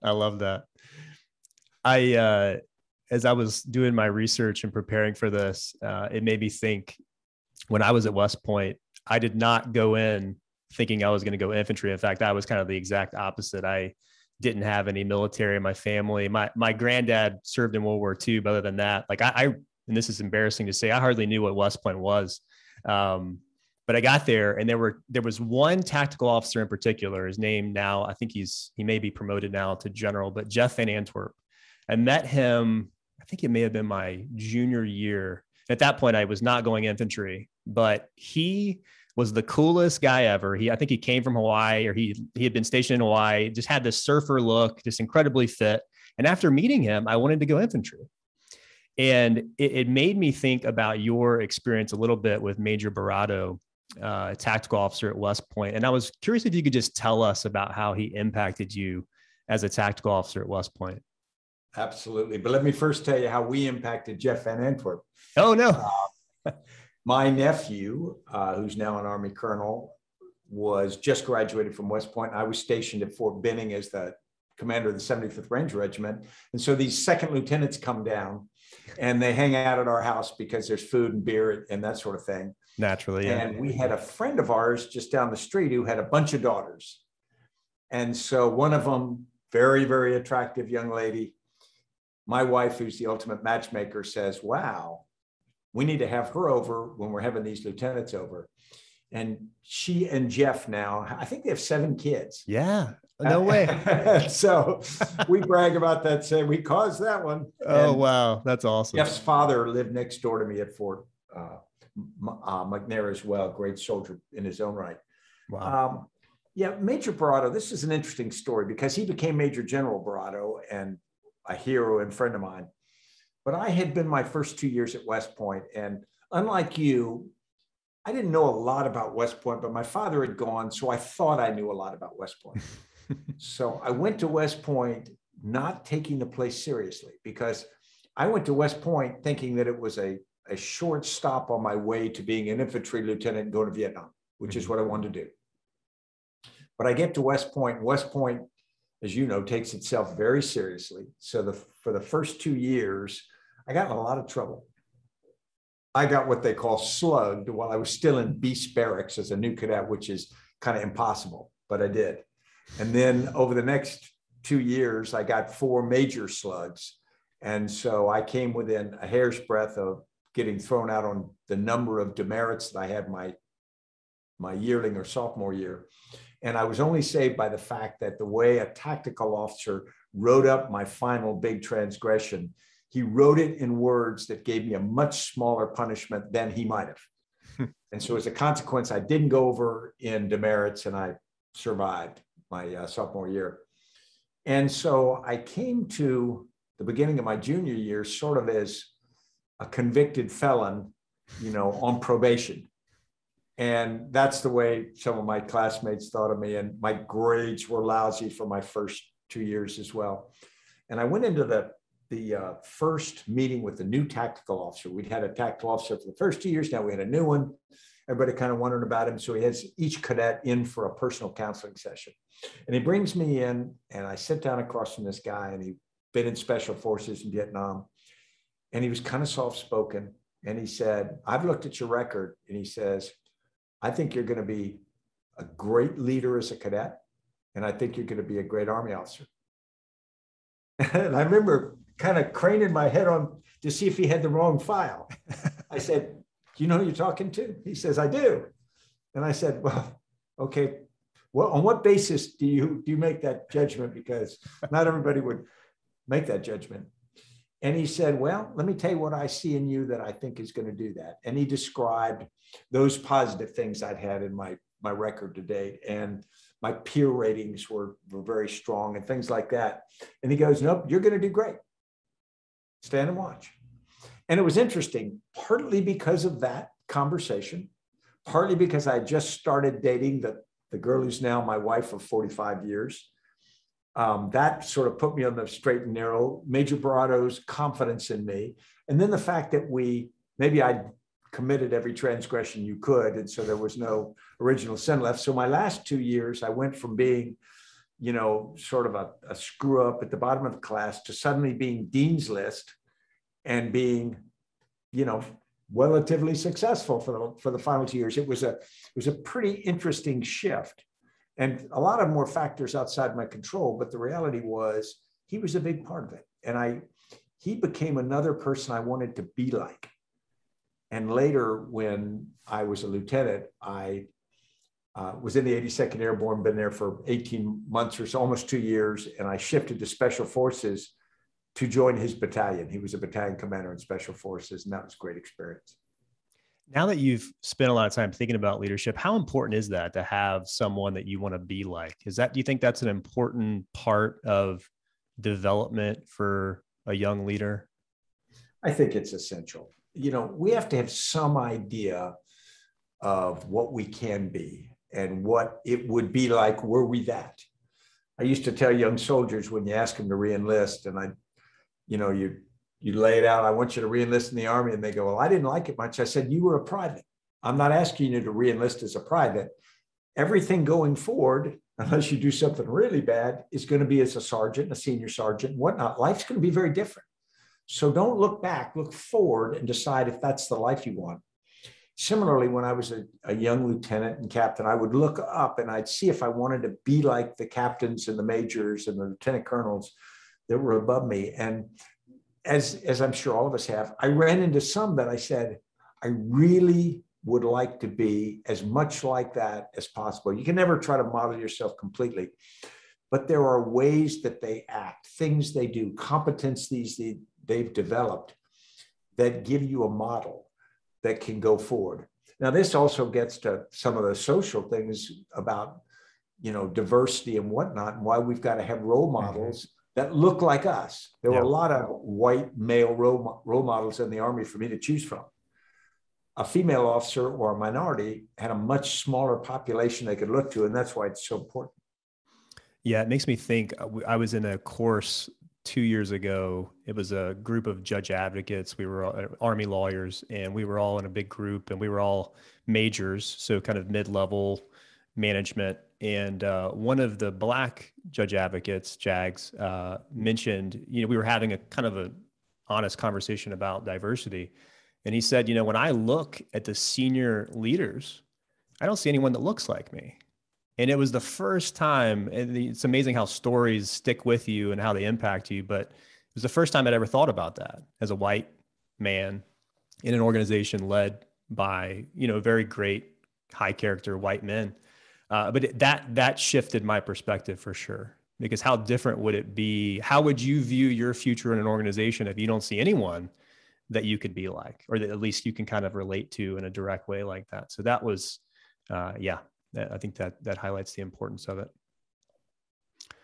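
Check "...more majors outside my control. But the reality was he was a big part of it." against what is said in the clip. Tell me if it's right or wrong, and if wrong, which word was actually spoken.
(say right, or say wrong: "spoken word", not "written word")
wrong: "factors", not "majors".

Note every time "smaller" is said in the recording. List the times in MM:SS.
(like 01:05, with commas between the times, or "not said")
03:05, 07:09.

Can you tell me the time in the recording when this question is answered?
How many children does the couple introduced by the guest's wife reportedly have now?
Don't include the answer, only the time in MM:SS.
01:41.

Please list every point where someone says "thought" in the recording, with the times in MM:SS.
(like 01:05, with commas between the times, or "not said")
02:10, 03:26, 07:47.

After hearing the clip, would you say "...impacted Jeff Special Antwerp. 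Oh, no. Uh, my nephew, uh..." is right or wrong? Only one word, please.
wrong.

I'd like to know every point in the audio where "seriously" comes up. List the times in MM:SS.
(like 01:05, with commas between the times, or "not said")
02:16, 02:30.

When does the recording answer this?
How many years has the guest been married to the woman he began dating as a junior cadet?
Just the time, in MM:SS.
04:42.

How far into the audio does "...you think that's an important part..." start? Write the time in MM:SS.
05:42.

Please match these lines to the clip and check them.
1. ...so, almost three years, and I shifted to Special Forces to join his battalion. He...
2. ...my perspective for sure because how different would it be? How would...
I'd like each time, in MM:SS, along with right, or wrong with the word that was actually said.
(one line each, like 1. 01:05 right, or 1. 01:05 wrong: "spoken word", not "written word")
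1. 05:28 wrong: "two", not "three"
2. 07:56 right.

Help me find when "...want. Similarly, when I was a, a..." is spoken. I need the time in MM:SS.
06:20.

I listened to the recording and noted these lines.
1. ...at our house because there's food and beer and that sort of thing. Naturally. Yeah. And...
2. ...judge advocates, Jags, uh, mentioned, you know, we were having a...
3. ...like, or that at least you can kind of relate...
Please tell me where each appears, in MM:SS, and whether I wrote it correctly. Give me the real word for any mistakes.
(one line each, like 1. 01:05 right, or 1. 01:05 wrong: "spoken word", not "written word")
1. 01:19 right
2. 07:28 right
3. 08:04 right.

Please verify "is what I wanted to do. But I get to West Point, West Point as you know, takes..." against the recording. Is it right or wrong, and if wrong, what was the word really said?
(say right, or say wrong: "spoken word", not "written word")
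right.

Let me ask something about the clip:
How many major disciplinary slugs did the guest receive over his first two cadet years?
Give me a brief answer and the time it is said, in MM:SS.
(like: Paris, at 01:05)
4, at 02:45.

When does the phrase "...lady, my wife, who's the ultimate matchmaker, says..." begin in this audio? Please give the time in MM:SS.
01:30.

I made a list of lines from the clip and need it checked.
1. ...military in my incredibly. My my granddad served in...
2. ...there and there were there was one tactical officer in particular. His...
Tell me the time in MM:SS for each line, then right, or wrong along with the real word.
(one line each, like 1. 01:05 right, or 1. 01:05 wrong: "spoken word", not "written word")
1. 00:15 wrong: "family", not "incredibly"
2. 00:24 right.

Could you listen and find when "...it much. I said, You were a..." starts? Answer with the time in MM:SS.
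06:05.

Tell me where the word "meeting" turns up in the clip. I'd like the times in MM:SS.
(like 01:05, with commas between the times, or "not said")
00:46, 03:33.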